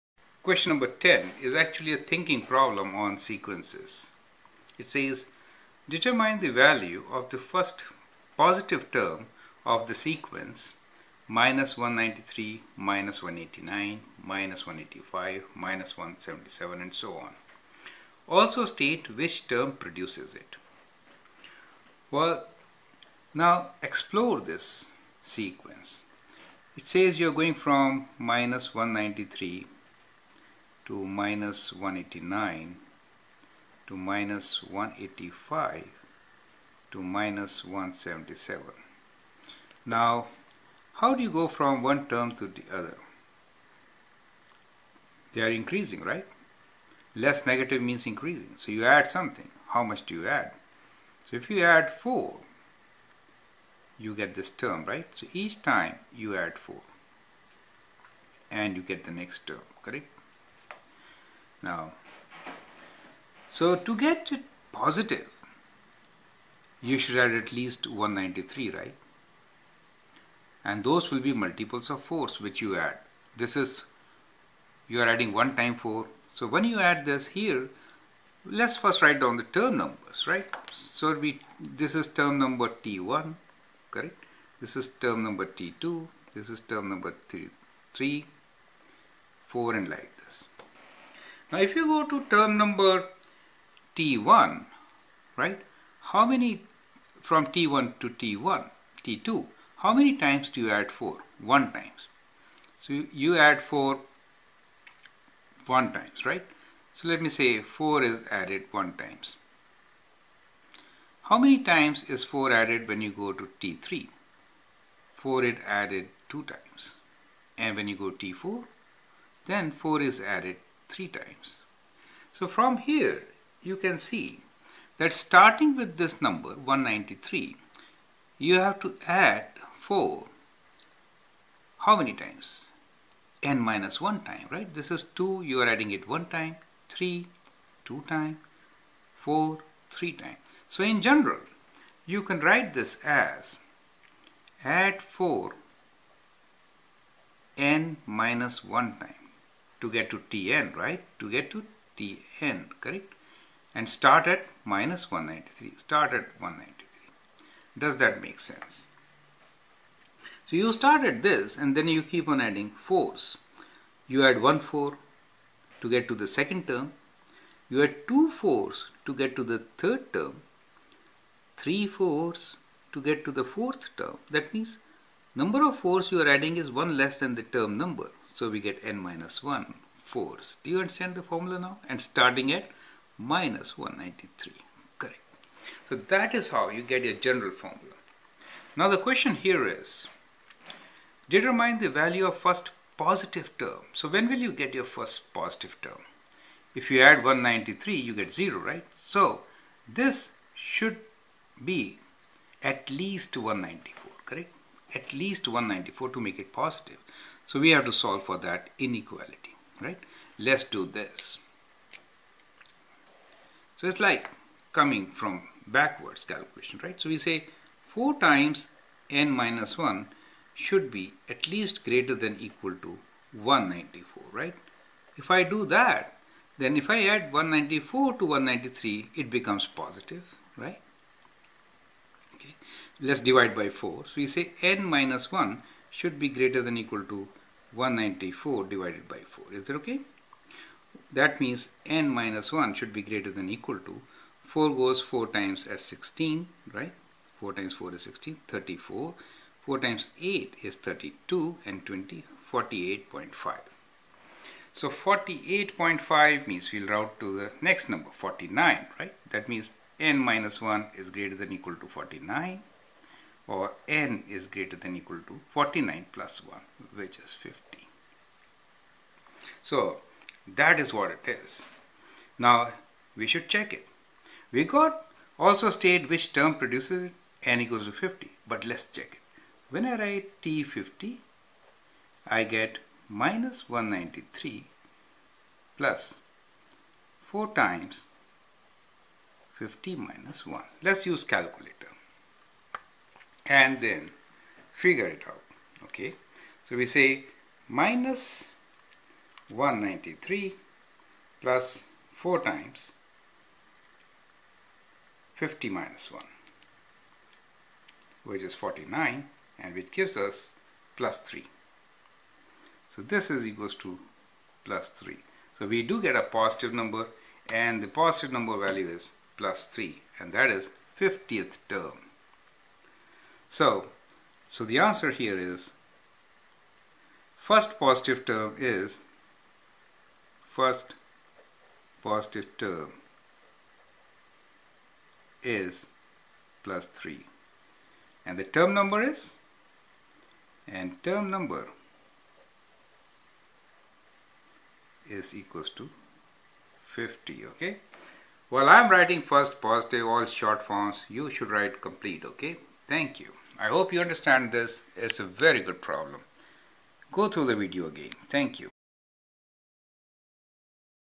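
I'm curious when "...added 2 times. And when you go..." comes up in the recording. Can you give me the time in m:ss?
1:55.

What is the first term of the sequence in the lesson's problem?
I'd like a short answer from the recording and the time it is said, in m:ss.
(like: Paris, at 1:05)
-193, at 0:11.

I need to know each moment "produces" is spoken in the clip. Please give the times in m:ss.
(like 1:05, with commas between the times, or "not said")
0:19, 4:36.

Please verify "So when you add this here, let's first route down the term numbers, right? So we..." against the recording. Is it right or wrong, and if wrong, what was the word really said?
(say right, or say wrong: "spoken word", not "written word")
wrong: "write", not "route".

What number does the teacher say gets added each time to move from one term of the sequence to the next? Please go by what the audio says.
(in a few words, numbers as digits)
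4.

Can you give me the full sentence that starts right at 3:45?
If I do that, then if I add 194 to 193, it becomes positive, right?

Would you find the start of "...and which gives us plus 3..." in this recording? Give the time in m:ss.
5:09.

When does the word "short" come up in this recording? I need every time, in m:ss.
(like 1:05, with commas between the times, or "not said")
5:50.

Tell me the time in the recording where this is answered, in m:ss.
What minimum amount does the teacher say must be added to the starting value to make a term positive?
3:24.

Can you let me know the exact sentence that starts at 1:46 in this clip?
So let me say 4 is added 1 times.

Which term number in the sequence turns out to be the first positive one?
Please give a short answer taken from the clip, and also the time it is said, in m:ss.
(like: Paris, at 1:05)
50, at 5:41.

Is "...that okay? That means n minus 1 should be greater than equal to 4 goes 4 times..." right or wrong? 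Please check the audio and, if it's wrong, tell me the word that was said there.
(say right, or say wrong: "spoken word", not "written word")
right.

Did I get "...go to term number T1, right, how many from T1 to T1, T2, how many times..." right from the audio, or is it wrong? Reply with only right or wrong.
right.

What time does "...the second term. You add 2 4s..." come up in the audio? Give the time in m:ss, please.
2:46.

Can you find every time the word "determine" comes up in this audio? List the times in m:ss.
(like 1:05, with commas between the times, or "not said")
0:05, 3:11.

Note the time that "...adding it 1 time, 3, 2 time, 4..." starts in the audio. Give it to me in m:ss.
2:15.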